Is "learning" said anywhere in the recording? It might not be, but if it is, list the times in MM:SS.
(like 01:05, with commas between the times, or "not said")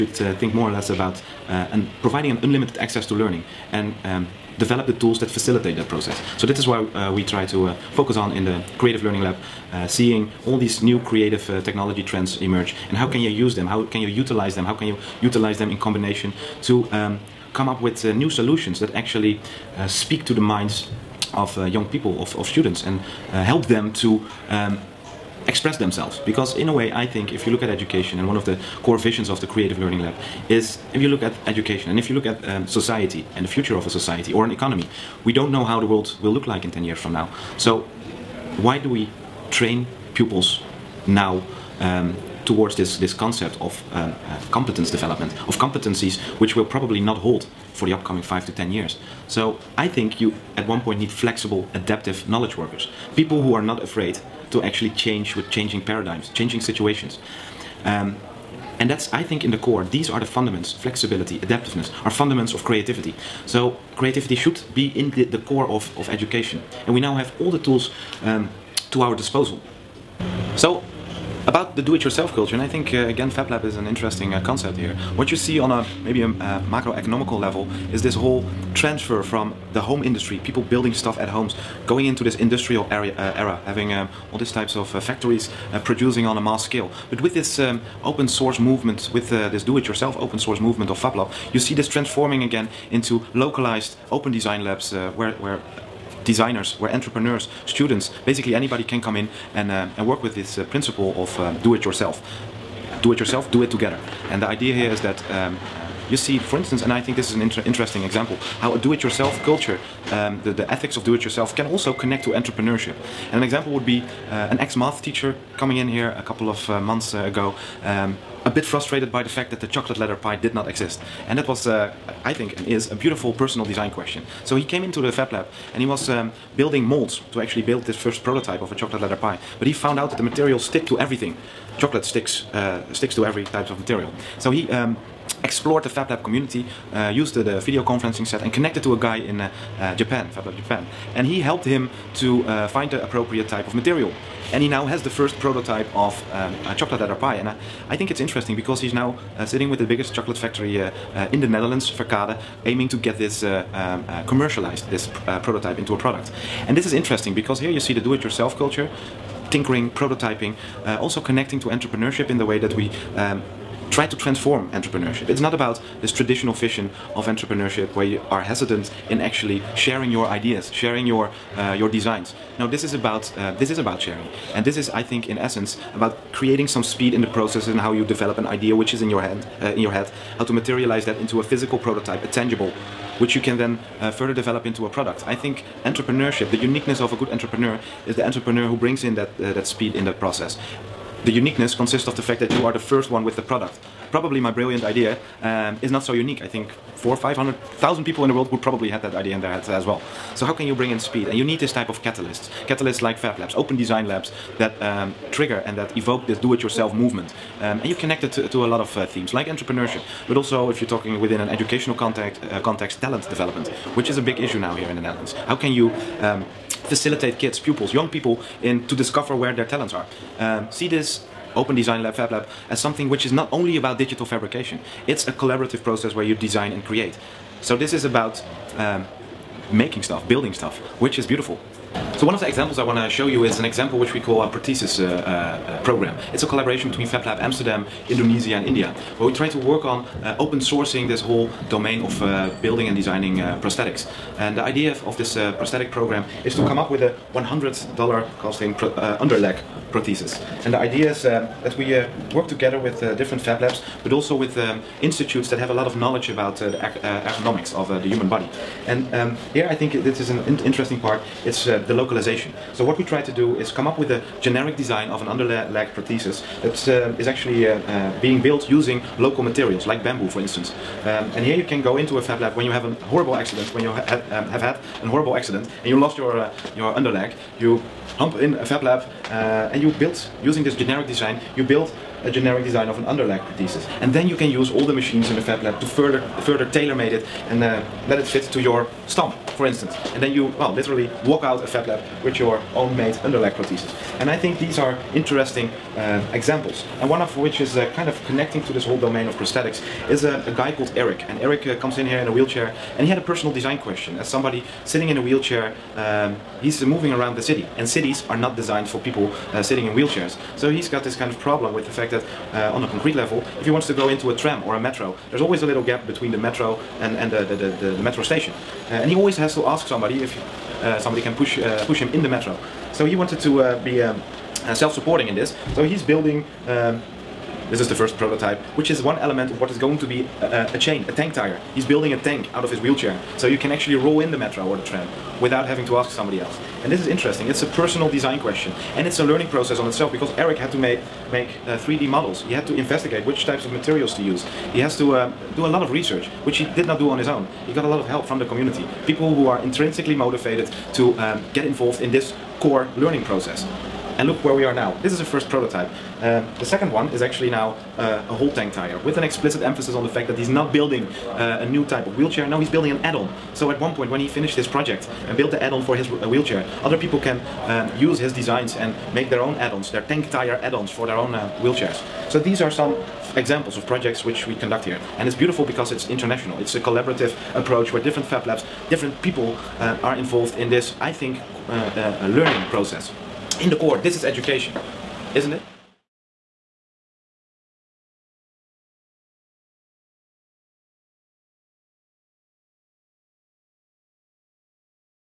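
00:03, 00:09, 00:29, 05:39, 05:52, 06:22.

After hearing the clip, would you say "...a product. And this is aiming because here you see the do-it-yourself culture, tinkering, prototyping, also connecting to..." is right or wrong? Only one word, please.
wrong.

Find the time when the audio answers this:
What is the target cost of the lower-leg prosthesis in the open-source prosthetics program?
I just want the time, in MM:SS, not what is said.
04:07.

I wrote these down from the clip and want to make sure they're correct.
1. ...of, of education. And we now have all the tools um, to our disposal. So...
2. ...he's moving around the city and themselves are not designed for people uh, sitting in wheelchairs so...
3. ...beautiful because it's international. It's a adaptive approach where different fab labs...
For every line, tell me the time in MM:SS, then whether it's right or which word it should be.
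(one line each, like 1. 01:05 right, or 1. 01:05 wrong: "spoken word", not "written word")
1. 01:05 right
2. 05:06 wrong: "cities", not "themselves"
3. 06:15 wrong: "collaborative", not "adaptive".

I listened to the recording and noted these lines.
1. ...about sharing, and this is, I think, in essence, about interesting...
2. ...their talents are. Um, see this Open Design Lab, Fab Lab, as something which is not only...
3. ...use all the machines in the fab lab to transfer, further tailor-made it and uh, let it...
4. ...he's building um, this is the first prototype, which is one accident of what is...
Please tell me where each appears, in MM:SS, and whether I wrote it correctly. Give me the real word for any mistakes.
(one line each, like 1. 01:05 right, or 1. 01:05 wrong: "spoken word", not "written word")
1. 02:53 wrong: "creating", not "interesting"
2. 03:39 right
3. 04:44 wrong: "further", not "transfer"
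4. 05:25 wrong: "element", not "accident".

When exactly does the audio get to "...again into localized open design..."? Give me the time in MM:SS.
01:32.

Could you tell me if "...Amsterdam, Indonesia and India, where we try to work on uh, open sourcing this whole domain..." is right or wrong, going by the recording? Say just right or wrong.
right.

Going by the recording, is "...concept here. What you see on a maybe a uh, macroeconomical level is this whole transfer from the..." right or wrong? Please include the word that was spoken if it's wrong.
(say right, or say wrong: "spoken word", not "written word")
right.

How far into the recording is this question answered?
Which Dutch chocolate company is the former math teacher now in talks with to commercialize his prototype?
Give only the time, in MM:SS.
02:31.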